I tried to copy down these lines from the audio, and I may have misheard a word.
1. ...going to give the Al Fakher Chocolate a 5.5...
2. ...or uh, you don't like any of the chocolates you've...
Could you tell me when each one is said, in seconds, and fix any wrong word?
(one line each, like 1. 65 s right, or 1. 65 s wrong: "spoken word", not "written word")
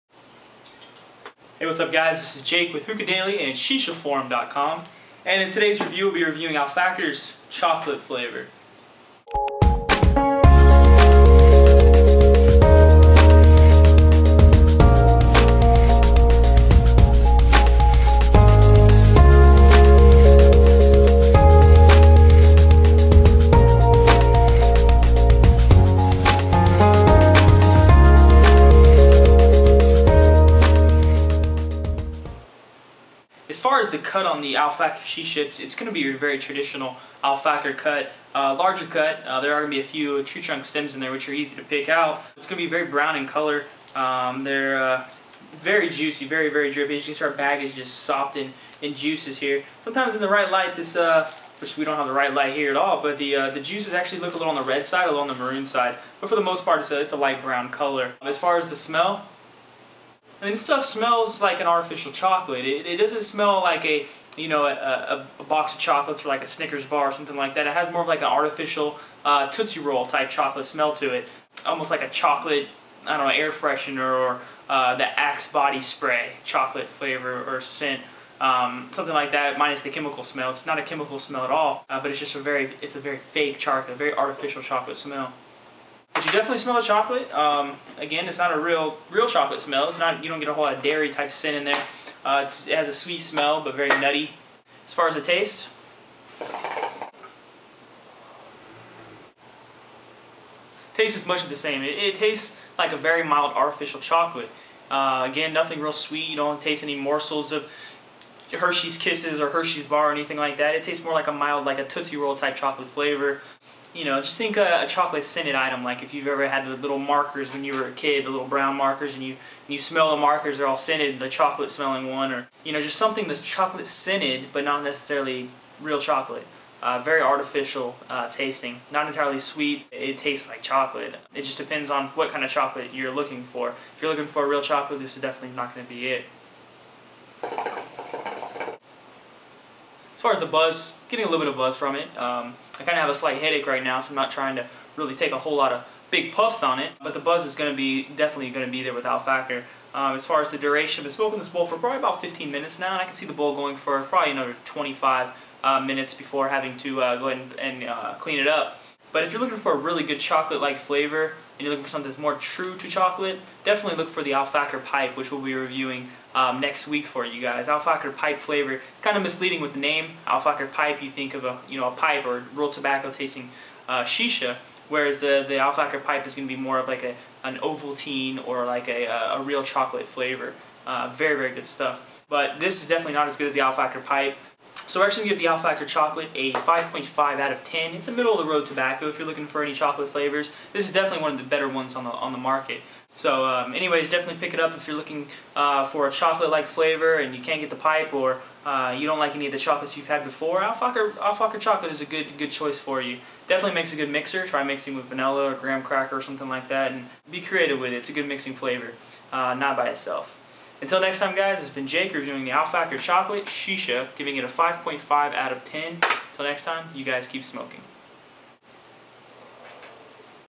1. 185 s right
2. 198 s right.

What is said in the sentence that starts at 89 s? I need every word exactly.
It's not you don't get a whole lot of dairy type scent in there.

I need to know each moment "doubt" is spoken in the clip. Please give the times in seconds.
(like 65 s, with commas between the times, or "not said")
not said.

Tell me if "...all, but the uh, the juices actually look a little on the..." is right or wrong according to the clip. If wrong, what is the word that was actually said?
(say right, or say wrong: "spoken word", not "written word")
right.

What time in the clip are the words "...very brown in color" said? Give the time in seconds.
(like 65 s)
42 s.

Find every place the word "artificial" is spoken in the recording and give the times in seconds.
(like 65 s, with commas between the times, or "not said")
61 s, 68 s, 84 s, 103 s, 127 s.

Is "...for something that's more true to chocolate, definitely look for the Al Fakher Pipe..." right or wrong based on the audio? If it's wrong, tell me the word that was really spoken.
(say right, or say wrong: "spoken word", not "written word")
right.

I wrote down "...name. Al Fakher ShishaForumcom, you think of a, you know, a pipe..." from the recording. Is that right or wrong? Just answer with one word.
wrong.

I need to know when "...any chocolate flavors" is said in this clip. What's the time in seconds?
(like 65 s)
189 s.